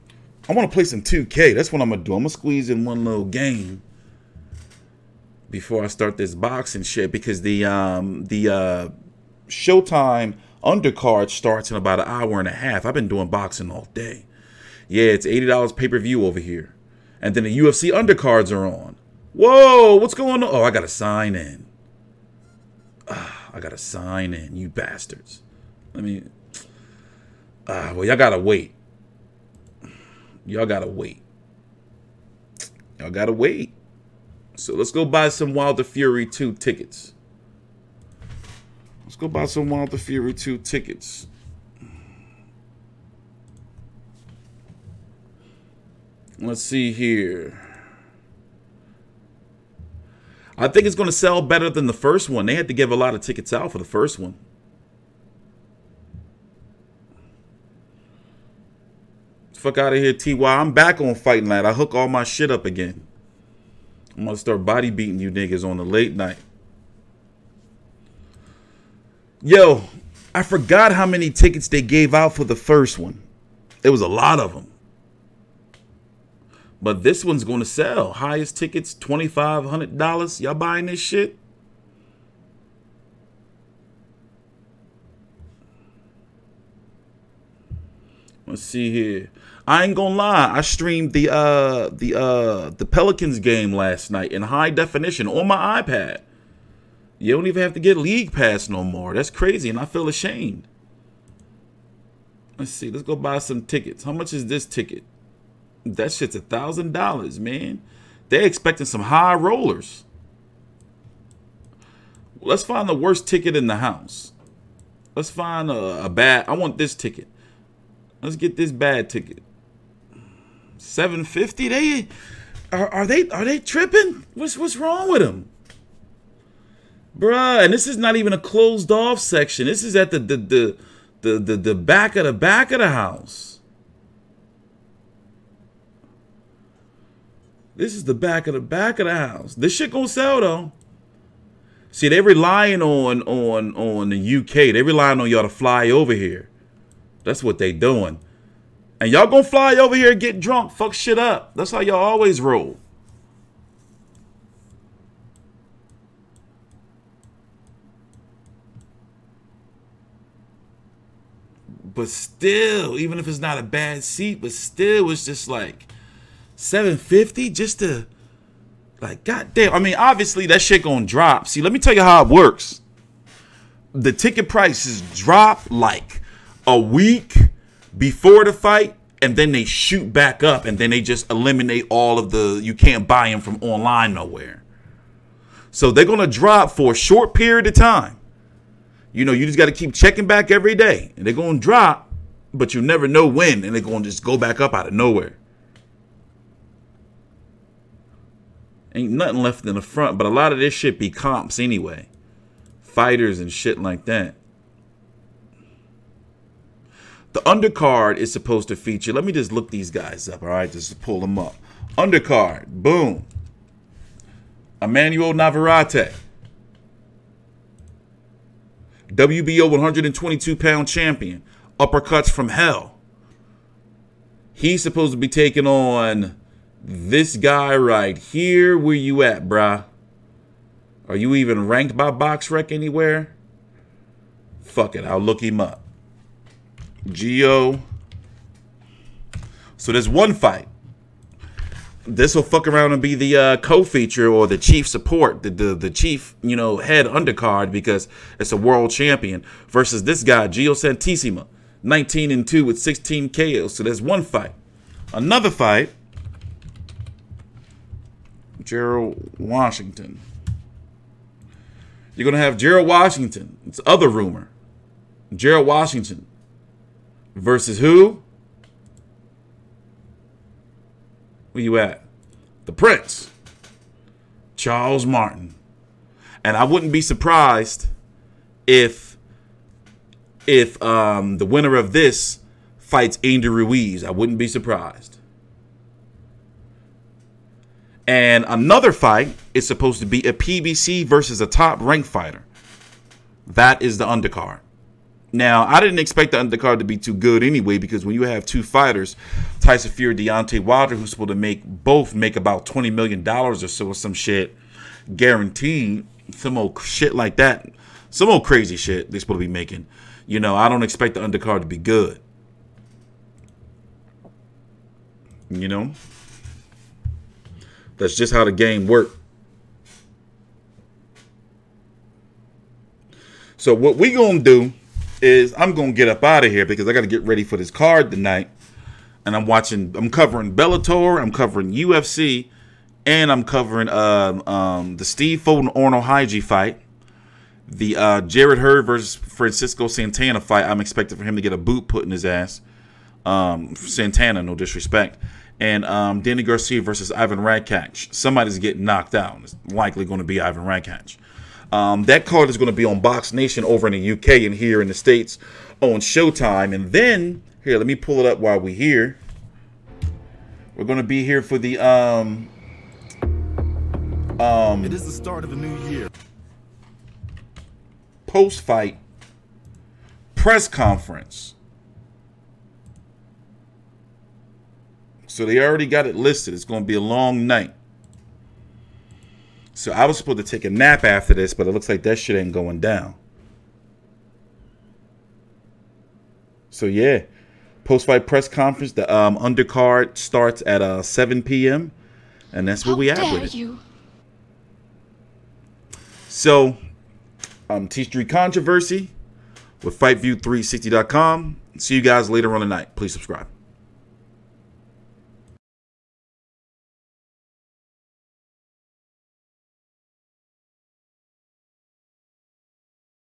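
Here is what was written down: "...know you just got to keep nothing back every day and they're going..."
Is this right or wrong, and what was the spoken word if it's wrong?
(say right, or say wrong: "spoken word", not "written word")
wrong: "checking", not "nothing".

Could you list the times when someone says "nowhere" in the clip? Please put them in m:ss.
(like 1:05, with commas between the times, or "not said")
3:04, 3:14.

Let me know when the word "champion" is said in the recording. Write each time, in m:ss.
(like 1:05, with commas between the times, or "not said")
3:40, 4:08.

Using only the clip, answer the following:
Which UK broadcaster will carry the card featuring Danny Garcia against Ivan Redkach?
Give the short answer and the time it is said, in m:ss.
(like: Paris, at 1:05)
Box Nation, at 5:52.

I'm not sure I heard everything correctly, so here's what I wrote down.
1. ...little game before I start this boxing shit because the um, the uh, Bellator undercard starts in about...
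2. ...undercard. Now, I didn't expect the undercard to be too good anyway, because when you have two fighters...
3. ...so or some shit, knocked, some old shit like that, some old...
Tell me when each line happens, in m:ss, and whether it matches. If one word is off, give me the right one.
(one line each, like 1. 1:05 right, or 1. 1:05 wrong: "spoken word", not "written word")
1. 0:03 wrong: "Showtime", not "Bellator"
2. 4:54 right
3. 5:03 wrong: "guaranteed", not "knocked".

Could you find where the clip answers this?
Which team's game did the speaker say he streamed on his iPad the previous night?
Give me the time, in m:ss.
1:32.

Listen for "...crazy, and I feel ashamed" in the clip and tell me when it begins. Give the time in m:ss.
1:39.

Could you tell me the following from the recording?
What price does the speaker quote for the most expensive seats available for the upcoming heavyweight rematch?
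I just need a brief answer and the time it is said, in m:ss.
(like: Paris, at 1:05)
$2,500, at 1:18.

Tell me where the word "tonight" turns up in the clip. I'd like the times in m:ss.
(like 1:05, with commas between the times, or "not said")
5:28, 6:42.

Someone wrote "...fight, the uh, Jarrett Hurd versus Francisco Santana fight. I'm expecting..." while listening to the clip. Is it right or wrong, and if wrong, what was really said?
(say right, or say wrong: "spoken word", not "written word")
right.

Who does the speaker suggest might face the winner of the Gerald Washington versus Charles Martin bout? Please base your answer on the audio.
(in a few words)
Andy Ruiz.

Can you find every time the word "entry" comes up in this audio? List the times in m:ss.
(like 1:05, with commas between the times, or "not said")
not said.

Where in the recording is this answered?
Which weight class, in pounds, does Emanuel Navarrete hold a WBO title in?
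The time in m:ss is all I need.
3:39.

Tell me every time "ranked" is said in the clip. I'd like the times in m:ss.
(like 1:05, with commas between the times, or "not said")
3:51, 4:51.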